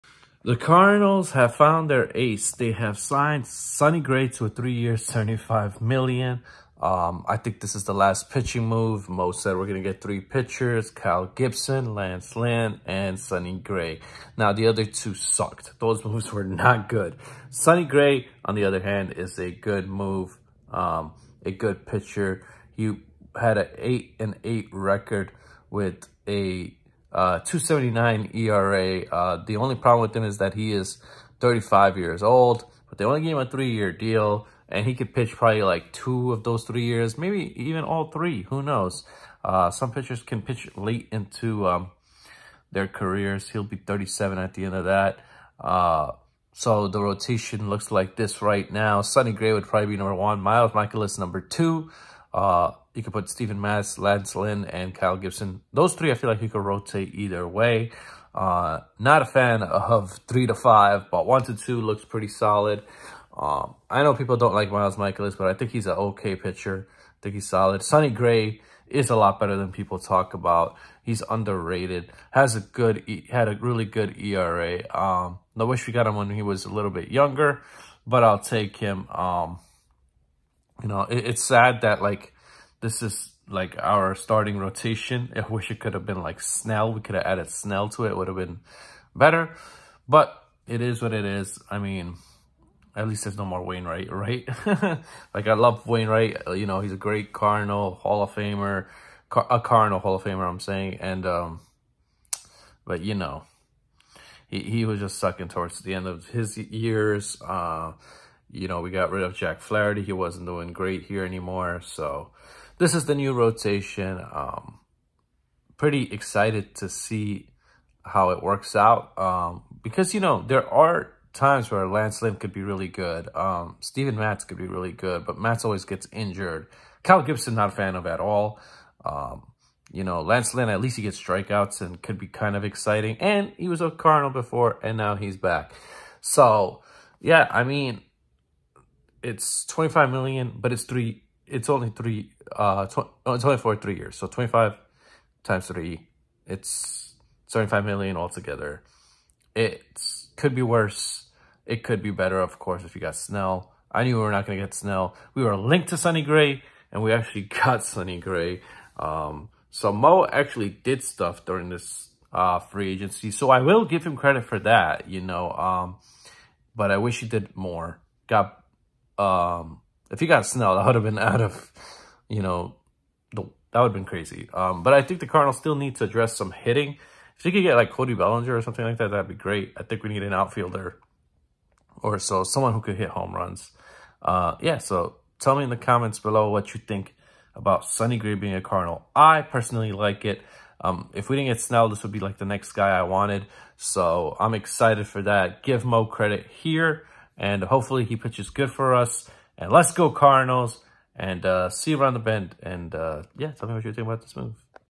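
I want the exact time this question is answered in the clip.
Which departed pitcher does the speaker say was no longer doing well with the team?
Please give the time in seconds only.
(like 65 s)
109 s.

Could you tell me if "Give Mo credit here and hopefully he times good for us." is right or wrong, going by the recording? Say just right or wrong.
wrong.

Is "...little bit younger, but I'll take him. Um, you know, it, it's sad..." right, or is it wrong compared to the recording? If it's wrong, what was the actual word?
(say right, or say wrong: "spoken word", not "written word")
right.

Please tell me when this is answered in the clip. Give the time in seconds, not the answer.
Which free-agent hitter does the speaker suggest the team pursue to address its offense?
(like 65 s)
177 s.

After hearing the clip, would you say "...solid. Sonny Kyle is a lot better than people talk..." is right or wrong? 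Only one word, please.
wrong.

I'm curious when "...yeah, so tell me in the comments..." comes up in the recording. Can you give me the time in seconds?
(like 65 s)
184 s.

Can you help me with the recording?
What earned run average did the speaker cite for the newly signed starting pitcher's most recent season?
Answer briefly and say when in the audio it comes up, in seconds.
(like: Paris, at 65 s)
2.79, at 27 s.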